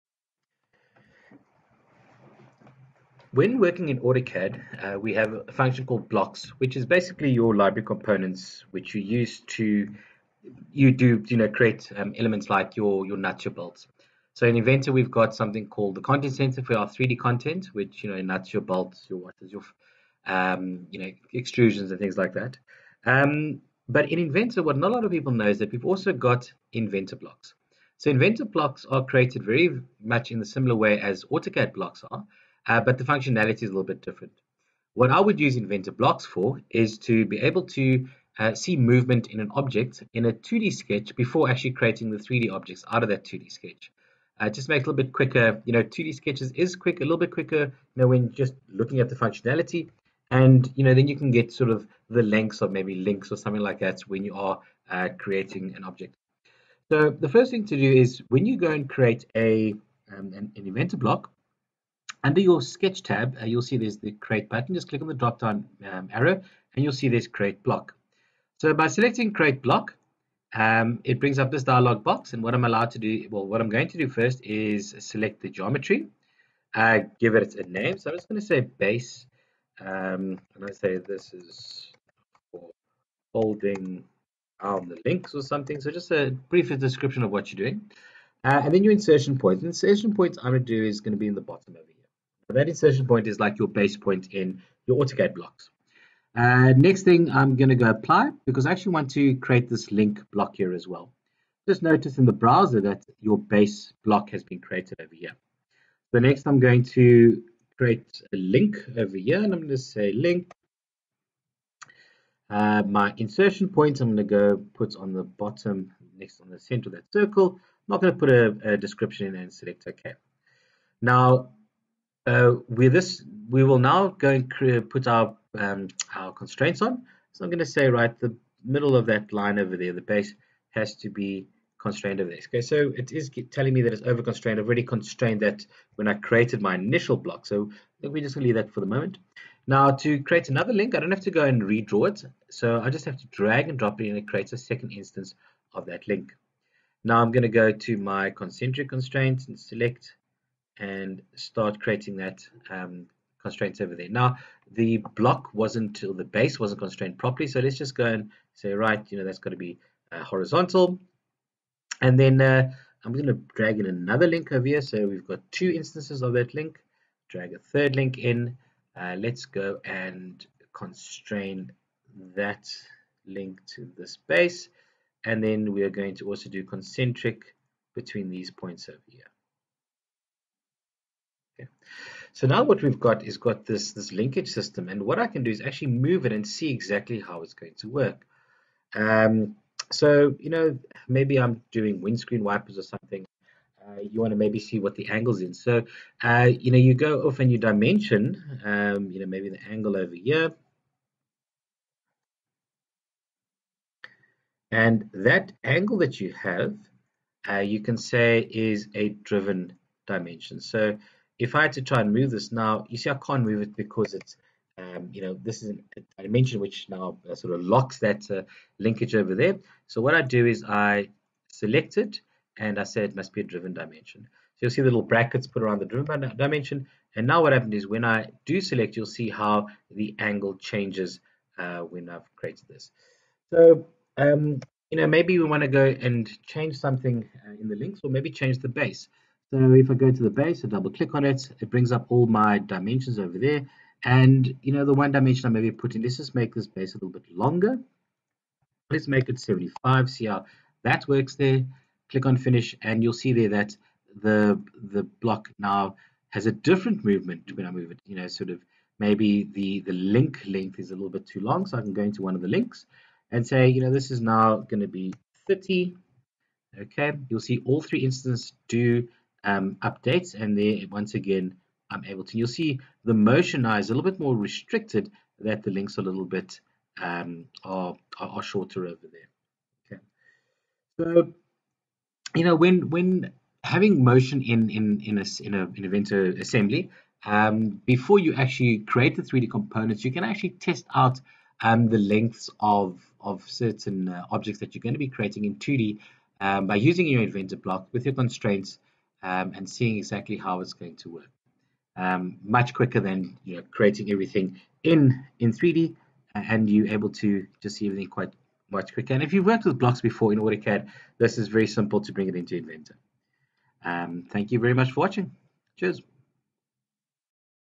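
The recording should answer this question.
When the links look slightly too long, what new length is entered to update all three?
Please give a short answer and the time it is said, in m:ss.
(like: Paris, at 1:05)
30, at 4:25.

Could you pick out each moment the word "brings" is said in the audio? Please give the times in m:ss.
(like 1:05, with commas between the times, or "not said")
1:11, 4:01, 5:12.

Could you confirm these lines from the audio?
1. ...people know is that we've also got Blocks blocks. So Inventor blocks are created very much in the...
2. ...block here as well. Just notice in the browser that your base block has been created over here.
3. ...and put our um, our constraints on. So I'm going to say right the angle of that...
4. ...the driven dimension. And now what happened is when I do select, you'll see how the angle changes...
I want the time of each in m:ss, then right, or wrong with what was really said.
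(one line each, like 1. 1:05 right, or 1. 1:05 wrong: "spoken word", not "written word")
1. 0:25 wrong: "Inventor", not "Blocks"
2. 1:40 right
3. 2:04 wrong: "middle", not "angle"
4. 3:45 right.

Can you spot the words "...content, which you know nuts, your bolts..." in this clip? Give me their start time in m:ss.
0:17.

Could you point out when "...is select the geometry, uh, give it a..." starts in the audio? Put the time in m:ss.
1:14.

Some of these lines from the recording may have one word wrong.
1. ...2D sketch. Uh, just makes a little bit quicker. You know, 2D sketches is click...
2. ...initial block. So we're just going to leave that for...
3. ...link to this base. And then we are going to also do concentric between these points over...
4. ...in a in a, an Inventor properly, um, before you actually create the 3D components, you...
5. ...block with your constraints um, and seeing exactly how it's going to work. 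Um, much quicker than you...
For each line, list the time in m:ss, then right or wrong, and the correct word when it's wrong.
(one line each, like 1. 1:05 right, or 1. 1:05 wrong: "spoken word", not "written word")
1. 0:43 wrong: "quick", not "click"
2. 2:16 right
3. 2:53 right
4. 4:45 wrong: "assembly", not "properly"
5. 4:57 right.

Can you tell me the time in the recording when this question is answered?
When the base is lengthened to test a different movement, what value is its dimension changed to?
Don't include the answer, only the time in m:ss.
4:09.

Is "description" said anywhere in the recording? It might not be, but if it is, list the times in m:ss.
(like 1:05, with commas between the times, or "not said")
1:26, 1:58.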